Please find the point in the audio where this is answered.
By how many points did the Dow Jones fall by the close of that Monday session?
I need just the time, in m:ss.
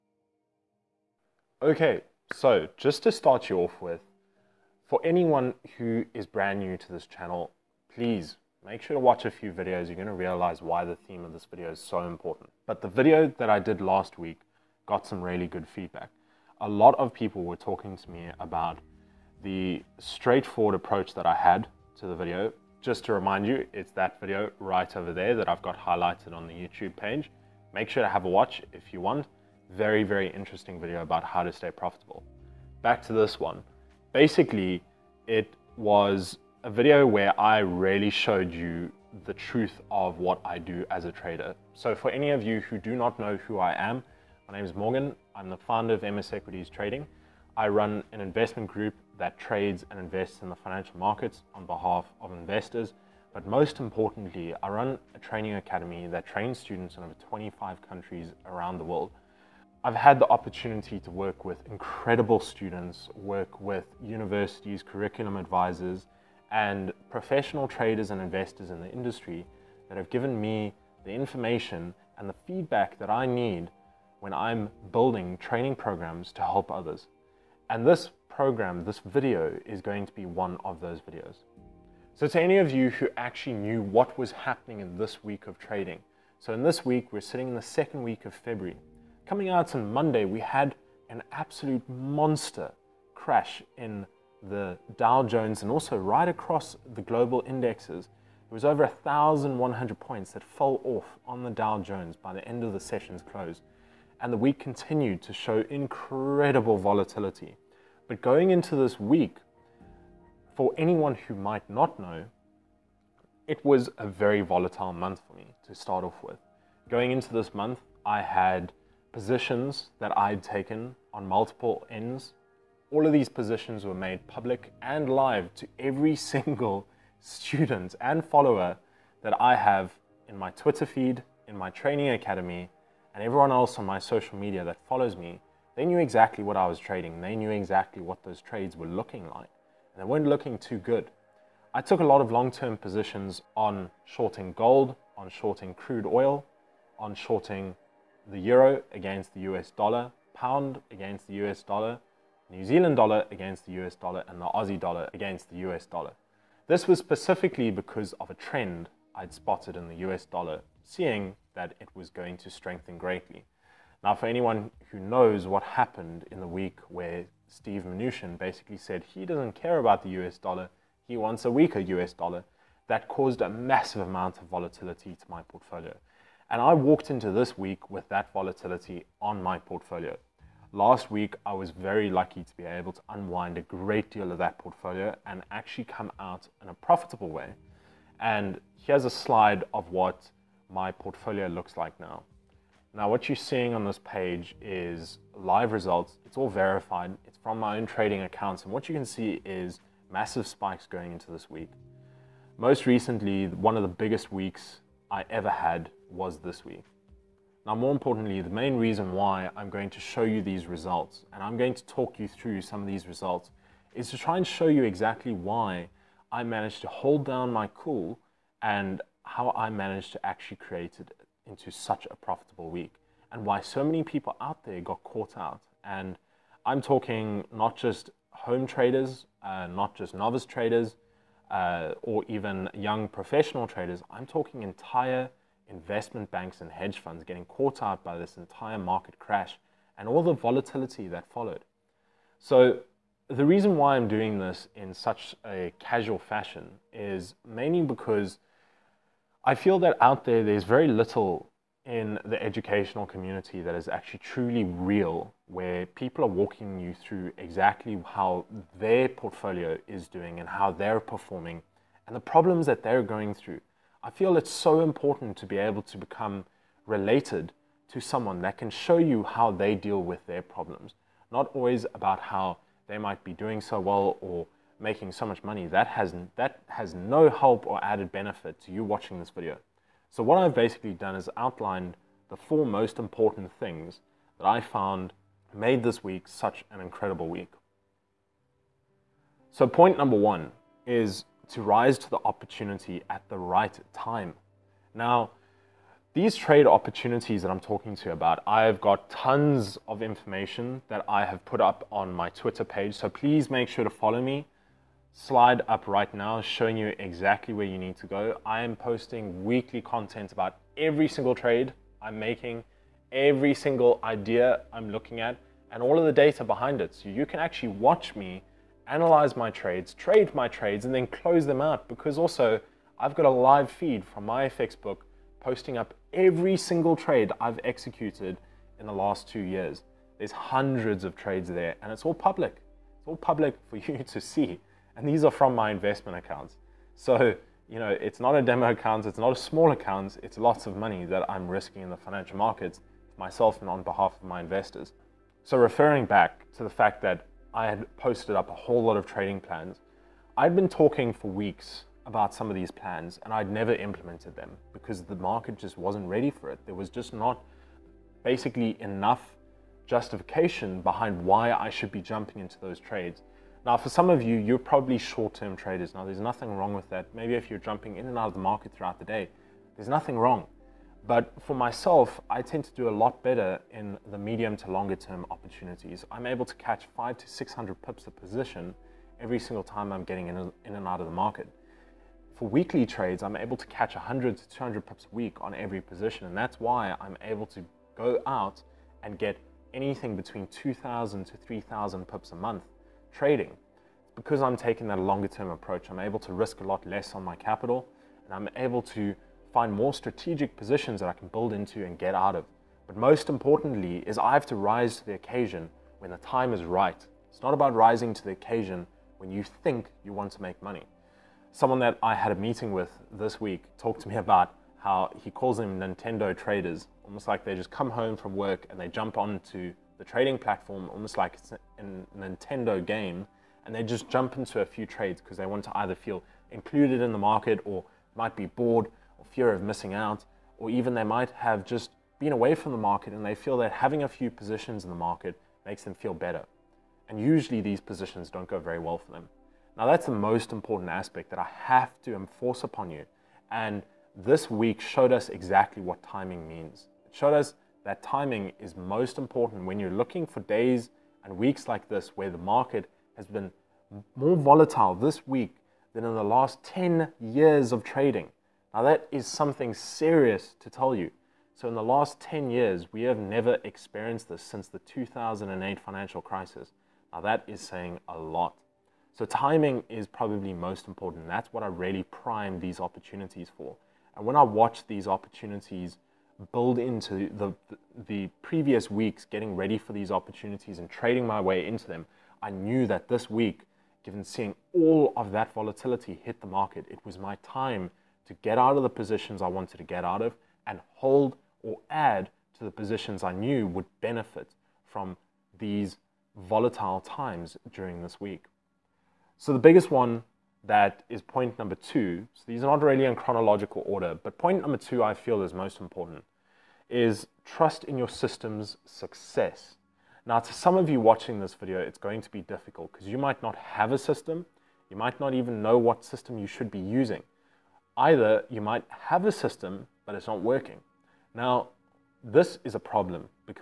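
1:38.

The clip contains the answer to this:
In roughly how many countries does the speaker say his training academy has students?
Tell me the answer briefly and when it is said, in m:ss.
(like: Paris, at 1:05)
over 25, at 0:57.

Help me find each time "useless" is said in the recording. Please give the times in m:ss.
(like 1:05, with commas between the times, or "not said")
not said.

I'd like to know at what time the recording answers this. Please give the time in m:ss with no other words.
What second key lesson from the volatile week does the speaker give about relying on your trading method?
8:27.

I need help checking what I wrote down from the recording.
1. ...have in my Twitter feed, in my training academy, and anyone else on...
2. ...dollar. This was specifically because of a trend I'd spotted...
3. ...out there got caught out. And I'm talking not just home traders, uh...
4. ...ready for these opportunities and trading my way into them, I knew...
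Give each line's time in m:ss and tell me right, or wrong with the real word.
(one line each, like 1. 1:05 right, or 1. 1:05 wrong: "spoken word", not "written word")
1. 2:09 wrong: "everyone", not "anyone"
2. 2:35 right
3. 3:44 right
4. 7:59 right.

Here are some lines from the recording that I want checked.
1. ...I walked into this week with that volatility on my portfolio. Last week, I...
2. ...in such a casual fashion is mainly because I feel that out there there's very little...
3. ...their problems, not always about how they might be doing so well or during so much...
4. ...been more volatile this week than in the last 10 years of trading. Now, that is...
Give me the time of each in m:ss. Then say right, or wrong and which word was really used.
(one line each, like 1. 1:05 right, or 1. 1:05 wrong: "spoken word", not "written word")
1. 2:56 right
2. 4:04 right
3. 4:30 wrong: "making", not "during"
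4. 7:33 right.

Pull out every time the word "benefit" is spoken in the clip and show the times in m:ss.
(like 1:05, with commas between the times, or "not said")
4:38, 8:14.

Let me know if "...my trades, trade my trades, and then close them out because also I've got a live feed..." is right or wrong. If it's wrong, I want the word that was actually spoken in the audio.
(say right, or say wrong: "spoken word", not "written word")
right.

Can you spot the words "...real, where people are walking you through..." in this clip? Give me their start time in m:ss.
4:14.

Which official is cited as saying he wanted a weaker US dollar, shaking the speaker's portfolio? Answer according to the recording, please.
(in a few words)
Steve Mnuchin.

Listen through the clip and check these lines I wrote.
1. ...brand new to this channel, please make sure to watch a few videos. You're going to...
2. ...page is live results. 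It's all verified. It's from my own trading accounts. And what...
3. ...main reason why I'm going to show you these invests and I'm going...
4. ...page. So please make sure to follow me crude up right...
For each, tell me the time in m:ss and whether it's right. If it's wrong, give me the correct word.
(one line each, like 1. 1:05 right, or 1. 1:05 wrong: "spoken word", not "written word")
1. 0:06 right
2. 3:14 right
3. 3:28 wrong: "results", not "invests"
4. 5:02 wrong: "slide", not "crude".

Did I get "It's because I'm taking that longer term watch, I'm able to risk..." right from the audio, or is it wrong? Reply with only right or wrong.
wrong.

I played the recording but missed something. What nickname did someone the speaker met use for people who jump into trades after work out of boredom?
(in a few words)
Nintendo traders.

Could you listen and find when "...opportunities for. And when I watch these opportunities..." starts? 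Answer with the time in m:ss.
7:52.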